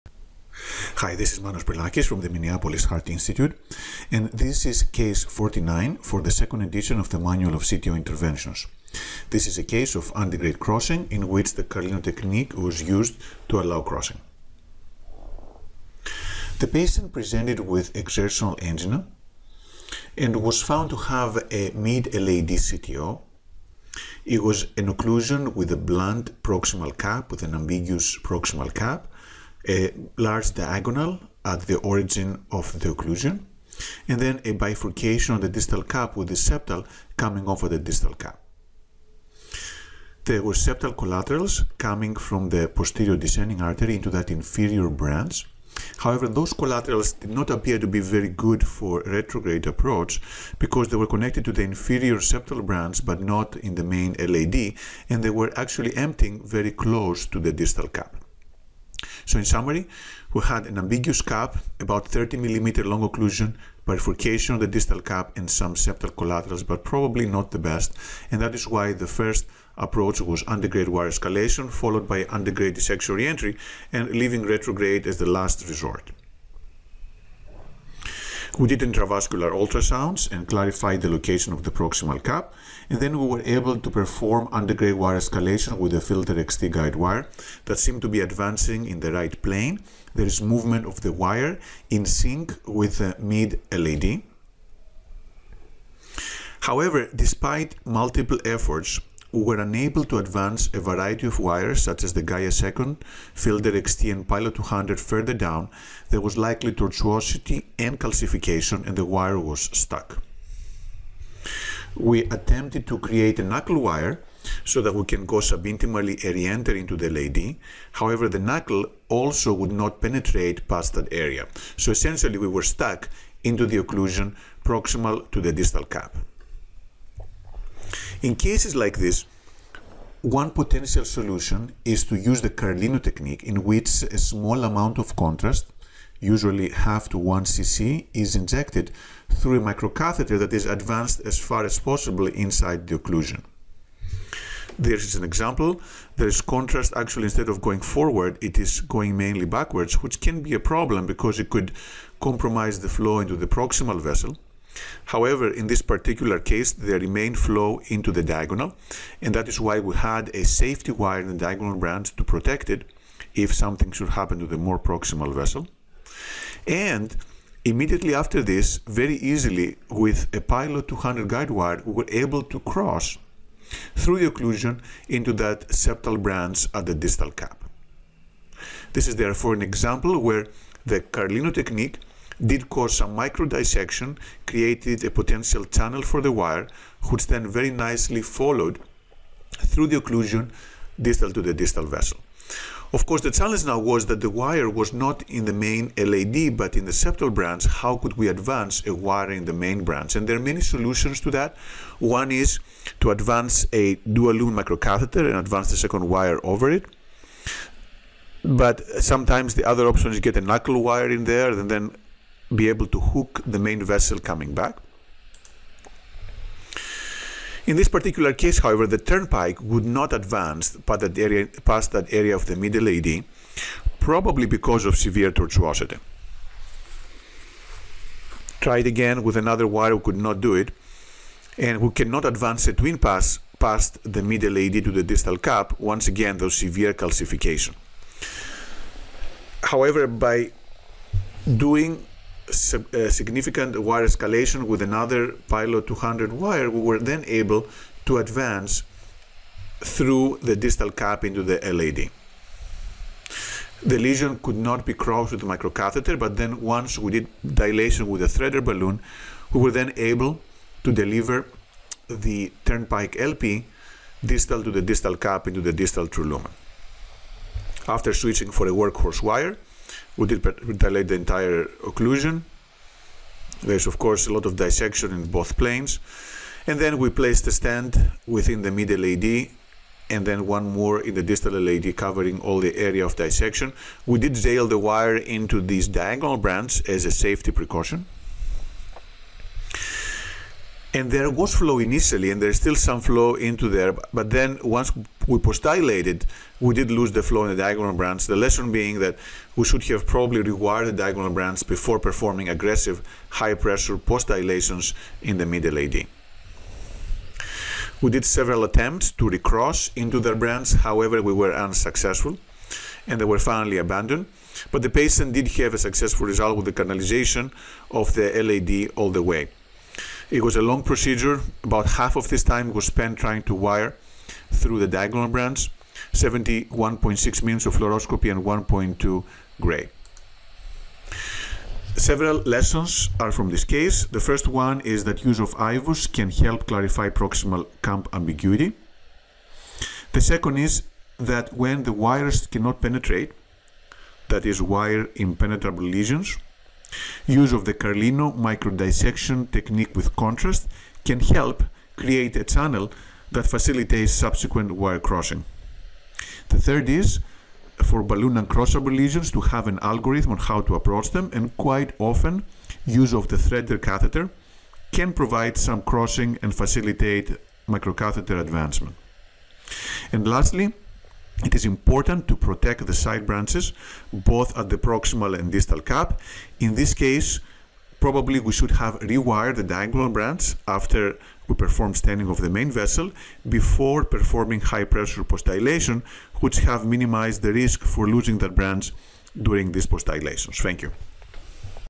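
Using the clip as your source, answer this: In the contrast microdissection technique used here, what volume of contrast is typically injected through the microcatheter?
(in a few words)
half to 1 cc.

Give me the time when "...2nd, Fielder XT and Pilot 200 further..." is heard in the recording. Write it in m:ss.
1:42.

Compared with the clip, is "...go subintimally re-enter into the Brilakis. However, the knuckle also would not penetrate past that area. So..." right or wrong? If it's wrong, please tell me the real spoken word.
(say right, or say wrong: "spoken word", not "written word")
wrong: "LAD", not "Brilakis".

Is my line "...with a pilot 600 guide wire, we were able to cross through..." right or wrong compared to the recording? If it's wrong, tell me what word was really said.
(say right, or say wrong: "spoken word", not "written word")
wrong: "200", not "600".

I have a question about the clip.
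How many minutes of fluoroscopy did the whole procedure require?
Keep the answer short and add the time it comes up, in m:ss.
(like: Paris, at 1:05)
71.6, at 5:26.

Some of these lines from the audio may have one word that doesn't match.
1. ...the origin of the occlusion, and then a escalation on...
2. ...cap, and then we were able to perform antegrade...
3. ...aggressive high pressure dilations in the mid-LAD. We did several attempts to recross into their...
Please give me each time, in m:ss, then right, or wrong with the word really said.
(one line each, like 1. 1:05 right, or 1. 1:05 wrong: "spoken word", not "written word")
1. 0:31 wrong: "bifurcation", not "escalation"
2. 1:22 right
3. 5:02 right.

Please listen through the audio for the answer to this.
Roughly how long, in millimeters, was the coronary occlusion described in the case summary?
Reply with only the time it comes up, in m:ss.
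1:02.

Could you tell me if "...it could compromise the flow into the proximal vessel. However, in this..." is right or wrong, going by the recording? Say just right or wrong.
right.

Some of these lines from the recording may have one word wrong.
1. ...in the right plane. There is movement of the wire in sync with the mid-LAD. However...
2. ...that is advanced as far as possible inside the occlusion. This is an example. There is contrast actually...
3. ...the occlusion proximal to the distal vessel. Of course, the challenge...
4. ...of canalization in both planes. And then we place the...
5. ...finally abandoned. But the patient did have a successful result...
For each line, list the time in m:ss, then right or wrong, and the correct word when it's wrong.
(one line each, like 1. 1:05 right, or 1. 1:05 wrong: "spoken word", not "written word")
1. 1:28 right
2. 2:20 right
3. 3:09 wrong: "distal", not "proximal"
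4. 4:34 wrong: "dissection", not "canalization"
5. 5:13 right.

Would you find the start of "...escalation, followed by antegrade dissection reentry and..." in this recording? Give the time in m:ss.
1:11.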